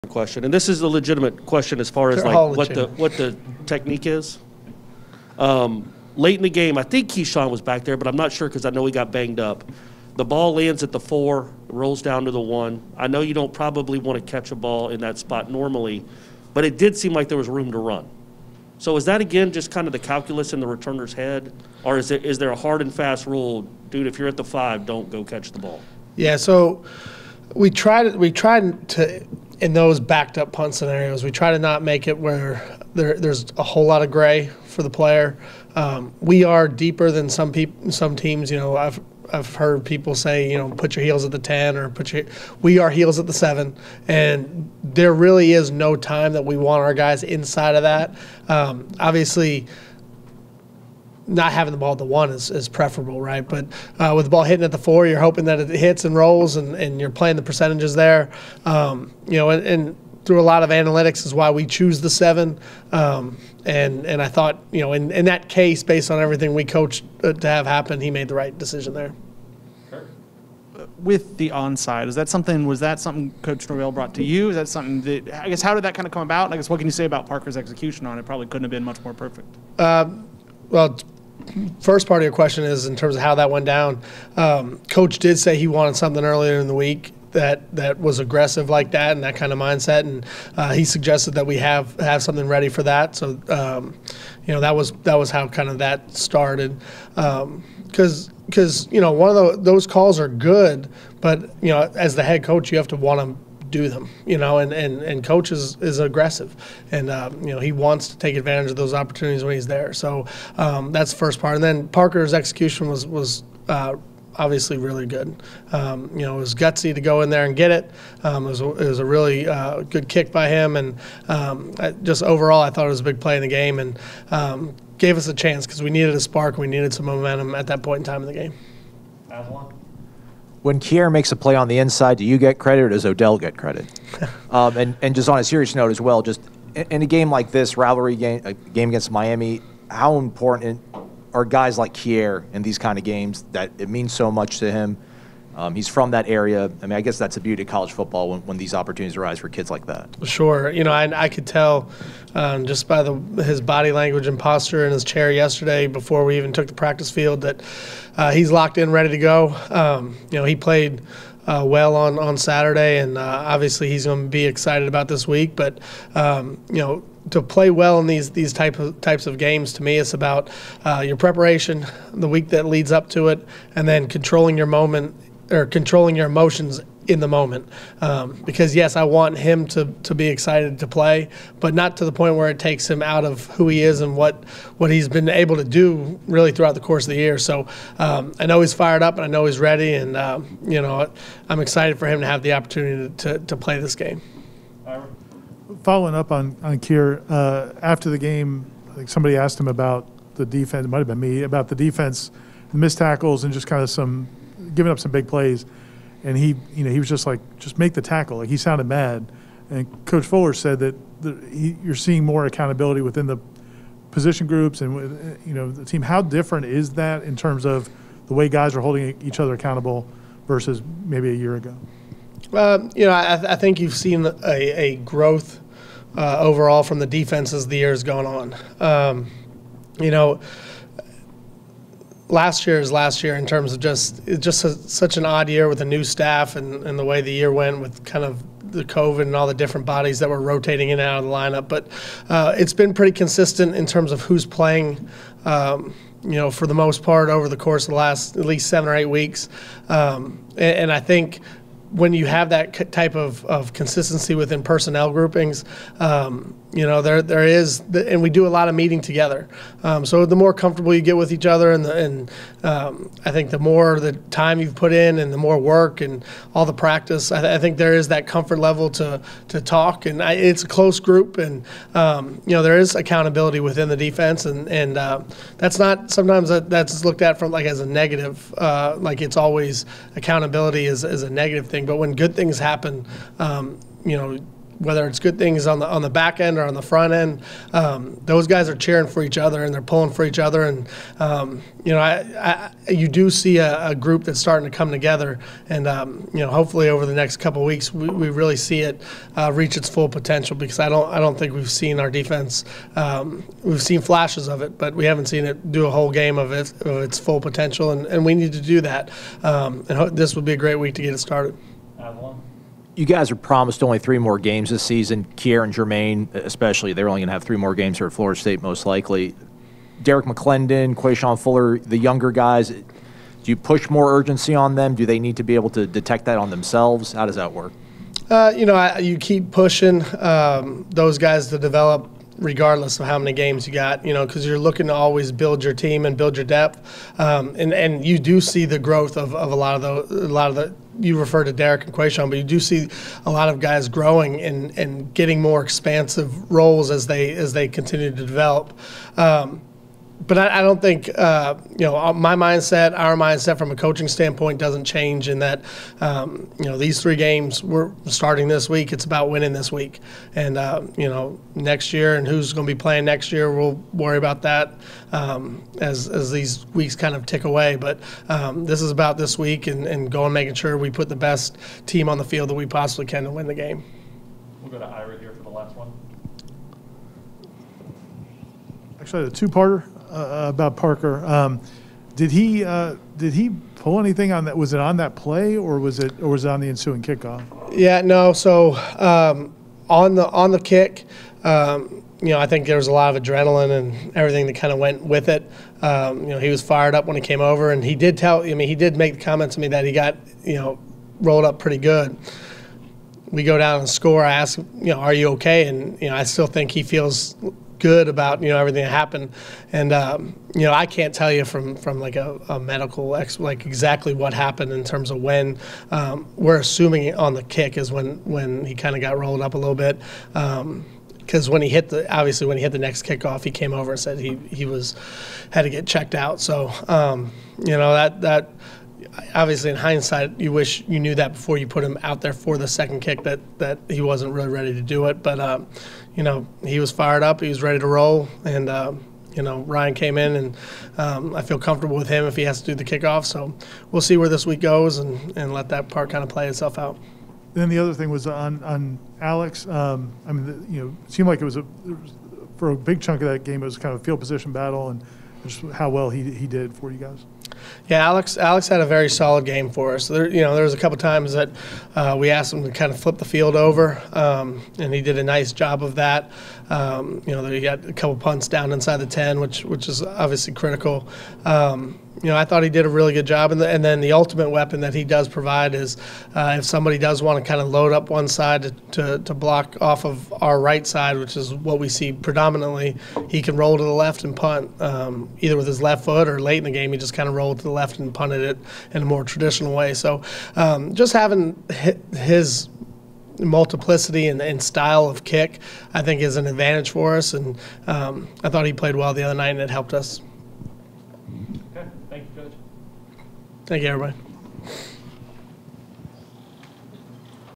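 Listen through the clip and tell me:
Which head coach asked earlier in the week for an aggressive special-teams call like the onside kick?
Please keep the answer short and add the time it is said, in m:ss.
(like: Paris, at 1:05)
Coach Norvell, at 1:13.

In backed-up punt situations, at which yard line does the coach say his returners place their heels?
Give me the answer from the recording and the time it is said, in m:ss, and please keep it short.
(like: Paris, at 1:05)
7, at 0:42.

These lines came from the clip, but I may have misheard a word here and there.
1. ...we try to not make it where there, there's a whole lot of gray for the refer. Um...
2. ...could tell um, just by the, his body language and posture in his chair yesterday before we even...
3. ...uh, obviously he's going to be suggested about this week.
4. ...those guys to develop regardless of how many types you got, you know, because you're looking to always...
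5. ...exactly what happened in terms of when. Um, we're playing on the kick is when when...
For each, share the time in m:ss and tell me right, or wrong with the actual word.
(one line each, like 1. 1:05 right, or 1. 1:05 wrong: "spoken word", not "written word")
1. 0:31 wrong: "player", not "refer"
2. 2:31 right
3. 2:43 wrong: "excited", not "suggested"
4. 5:30 wrong: "games", not "types"
5. 6:53 wrong: "assuming", not "playing".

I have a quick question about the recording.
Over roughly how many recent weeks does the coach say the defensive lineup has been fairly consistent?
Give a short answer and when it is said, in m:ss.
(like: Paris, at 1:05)
7 or 8 weeks, at 4:08.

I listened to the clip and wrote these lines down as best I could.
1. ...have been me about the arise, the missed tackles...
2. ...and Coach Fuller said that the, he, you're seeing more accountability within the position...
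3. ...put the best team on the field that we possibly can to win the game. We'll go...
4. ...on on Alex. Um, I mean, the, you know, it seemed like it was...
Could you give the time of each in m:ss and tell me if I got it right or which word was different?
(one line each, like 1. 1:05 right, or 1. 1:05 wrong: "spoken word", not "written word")
1. 3:20 wrong: "defense", not "arise"
2. 3:29 right
3. 6:10 right
4. 7:28 right.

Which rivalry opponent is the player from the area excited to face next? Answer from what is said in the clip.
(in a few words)
Miami.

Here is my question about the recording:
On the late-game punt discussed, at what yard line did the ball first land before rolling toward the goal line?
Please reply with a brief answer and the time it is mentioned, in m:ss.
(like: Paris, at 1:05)
4, at 0:10.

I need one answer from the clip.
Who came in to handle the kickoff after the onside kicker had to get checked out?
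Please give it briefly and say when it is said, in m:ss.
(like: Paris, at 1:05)
Ryan, at 7:19.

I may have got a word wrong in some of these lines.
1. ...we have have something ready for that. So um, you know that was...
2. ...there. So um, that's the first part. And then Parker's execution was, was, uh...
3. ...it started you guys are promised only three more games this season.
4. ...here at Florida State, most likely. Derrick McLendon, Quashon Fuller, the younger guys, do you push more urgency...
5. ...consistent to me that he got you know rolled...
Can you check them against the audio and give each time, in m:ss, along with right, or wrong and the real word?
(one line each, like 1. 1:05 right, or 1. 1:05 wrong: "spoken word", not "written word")
1. 1:31 right
2. 1:49 right
3. 5:11 right
4. 5:17 right
5. 6:39 wrong: "comment", not "consistent".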